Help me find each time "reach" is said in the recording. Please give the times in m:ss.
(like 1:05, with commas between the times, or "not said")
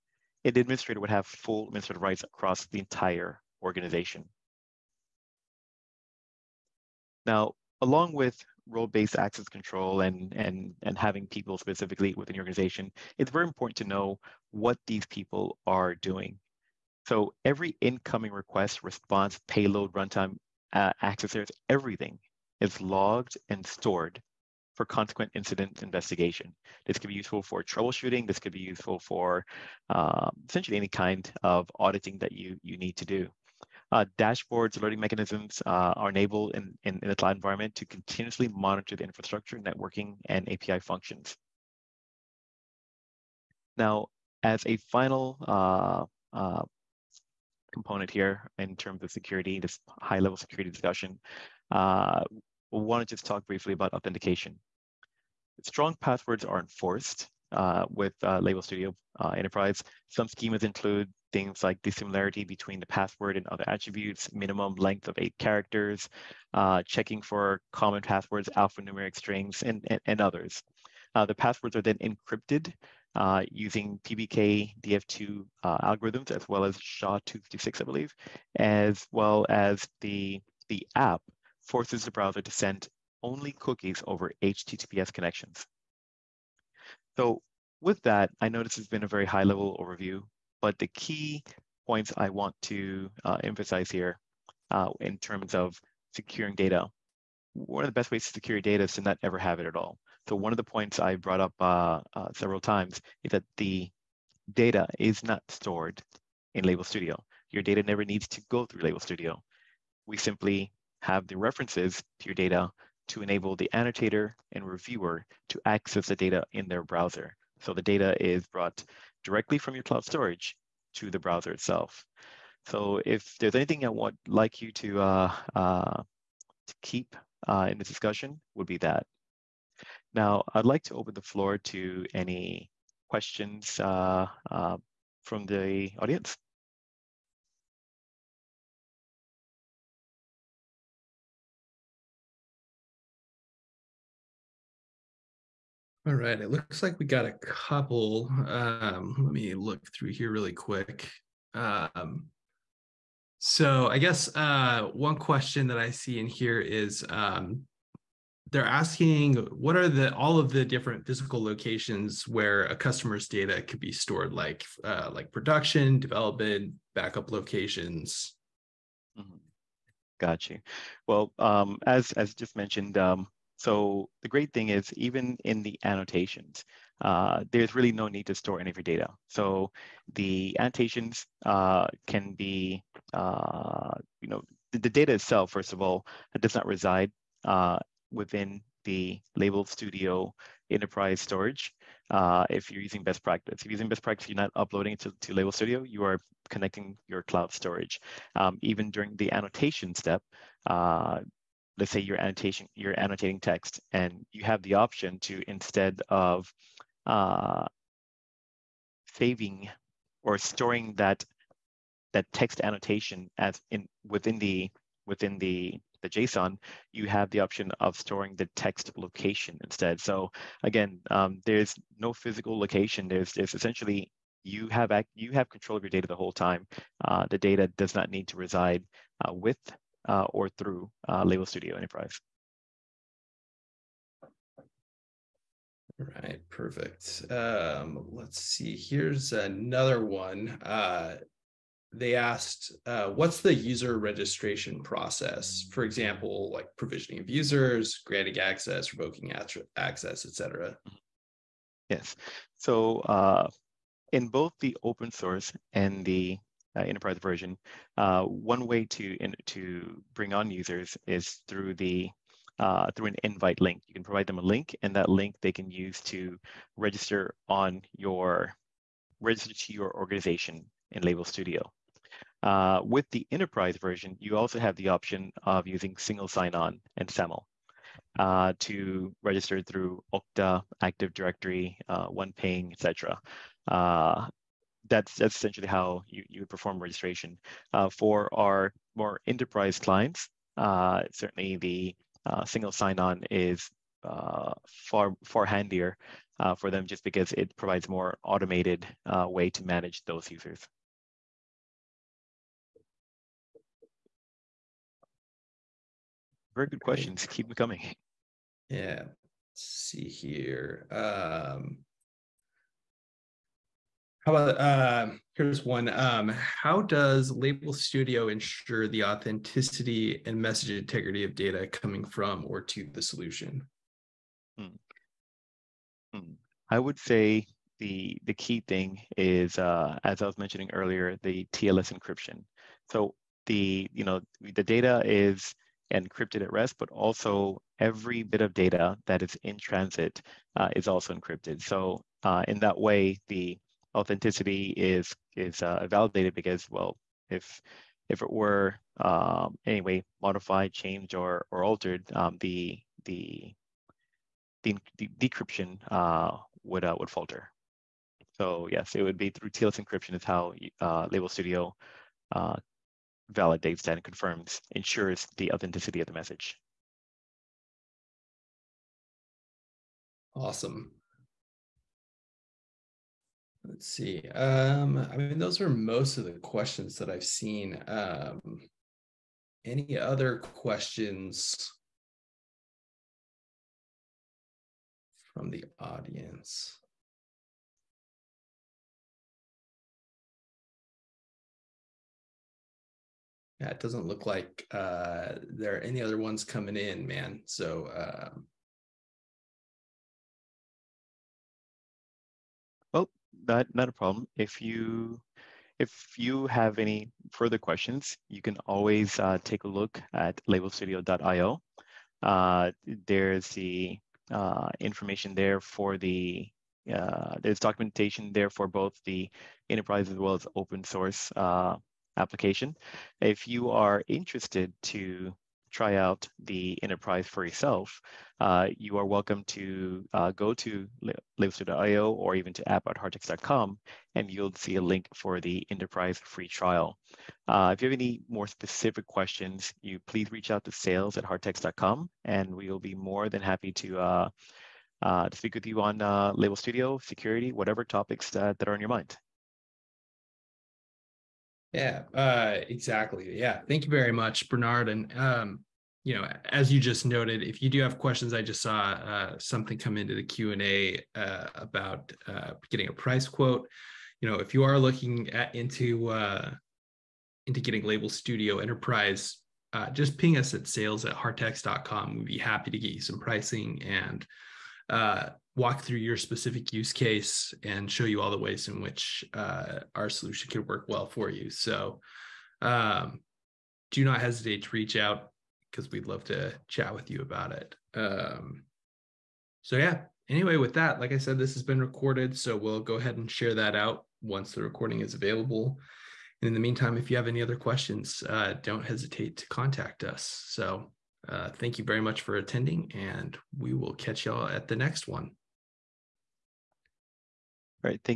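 7:20, 8:04.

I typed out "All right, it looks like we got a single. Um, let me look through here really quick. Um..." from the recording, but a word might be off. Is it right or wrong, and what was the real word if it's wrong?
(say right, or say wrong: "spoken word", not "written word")
wrong: "couple", not "single".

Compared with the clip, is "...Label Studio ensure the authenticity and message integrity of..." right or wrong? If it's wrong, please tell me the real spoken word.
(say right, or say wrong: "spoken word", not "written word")
right.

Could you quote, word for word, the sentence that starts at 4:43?
Uh, that's, that's essentially how you, you would perform registration.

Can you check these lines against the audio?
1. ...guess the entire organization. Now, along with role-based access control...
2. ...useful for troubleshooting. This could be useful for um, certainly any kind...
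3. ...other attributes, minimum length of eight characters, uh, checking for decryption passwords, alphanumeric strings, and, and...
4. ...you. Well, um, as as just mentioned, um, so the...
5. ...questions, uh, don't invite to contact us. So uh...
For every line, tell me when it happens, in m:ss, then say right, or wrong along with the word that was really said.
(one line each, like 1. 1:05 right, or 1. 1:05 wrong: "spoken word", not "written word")
1. 0:02 wrong: "across", not "guess"
2. 0:27 wrong: "essentially", not "certainly"
3. 1:03 wrong: "common", not "decryption"
4. 2:50 right
5. 8:17 wrong: "hesitate", not "invite".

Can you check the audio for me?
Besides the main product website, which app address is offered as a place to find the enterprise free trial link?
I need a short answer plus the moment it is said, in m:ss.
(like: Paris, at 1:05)
app.heartex.com, at 7:12.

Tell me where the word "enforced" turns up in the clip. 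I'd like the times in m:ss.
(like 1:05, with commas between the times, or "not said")
0:56.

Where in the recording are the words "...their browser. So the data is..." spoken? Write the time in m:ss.
1:56.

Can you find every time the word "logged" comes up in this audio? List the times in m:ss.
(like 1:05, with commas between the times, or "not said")
0:22.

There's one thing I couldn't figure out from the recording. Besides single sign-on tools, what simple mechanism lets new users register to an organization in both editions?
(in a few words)
An invite link.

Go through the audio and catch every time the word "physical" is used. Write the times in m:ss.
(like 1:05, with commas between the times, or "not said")
2:41, 3:42.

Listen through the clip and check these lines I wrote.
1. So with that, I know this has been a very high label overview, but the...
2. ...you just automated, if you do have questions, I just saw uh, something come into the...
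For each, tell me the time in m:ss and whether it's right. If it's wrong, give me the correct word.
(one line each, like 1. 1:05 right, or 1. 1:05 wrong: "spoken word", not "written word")
1. 1:27 wrong: "level", not "label"
2. 7:36 wrong: "noted", not "automated".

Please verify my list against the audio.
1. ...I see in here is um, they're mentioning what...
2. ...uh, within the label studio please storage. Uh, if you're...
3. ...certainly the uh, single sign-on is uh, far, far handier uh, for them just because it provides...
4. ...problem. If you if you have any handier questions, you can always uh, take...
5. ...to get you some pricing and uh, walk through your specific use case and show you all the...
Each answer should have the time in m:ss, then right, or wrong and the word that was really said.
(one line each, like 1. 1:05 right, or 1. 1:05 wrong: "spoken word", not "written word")
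1. 2:35 wrong: "asking", not "mentioning"
2. 3:07 wrong: "enterprise", not "please"
3. 4:51 right
4. 6:43 wrong: "further", not "handier"
5. 7:52 right.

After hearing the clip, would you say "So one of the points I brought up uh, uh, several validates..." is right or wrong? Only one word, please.
wrong.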